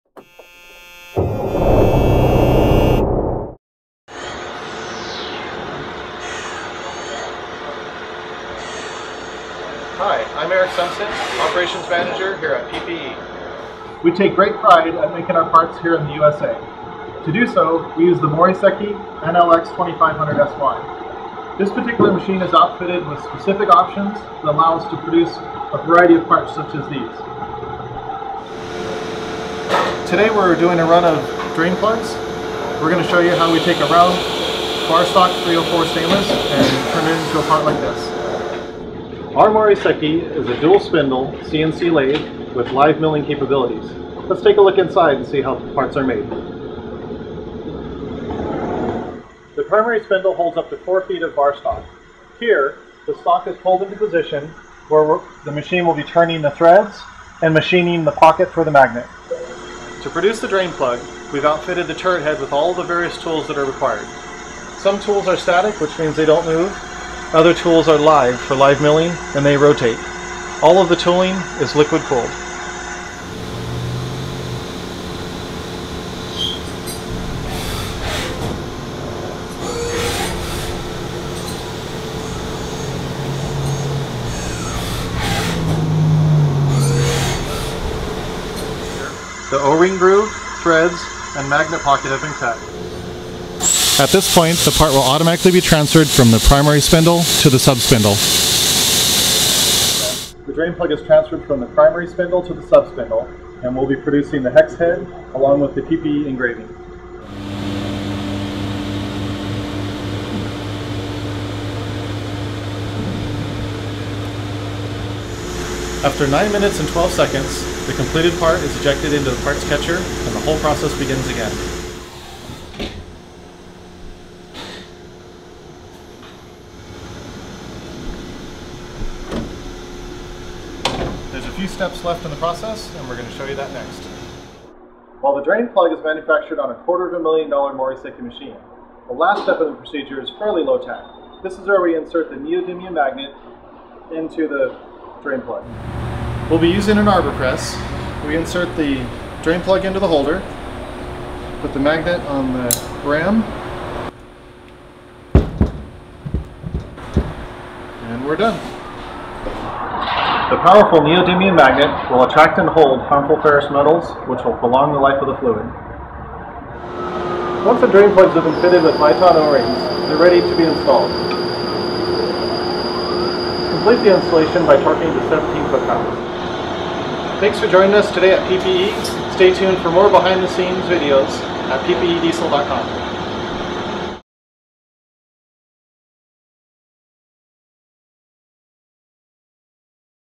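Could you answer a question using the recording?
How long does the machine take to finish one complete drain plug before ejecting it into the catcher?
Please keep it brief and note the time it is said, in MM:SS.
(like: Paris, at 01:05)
9 minutes and 12 seconds, at 01:56.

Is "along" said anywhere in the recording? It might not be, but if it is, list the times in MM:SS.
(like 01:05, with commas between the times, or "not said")
01:45.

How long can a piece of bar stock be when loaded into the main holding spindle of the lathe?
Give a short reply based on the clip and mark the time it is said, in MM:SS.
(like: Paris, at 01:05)
4 feet, at 00:50.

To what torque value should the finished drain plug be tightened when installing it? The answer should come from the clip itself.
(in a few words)
17 foot-pounds.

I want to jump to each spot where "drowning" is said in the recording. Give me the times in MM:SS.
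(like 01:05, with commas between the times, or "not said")
not said.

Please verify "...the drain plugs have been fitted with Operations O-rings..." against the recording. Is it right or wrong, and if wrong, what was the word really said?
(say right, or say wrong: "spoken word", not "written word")
wrong: "Viton", not "Operations".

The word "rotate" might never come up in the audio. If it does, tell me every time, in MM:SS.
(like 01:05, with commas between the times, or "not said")
01:09.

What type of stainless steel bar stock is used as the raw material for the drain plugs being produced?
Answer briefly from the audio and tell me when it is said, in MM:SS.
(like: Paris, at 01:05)
304, at 00:35.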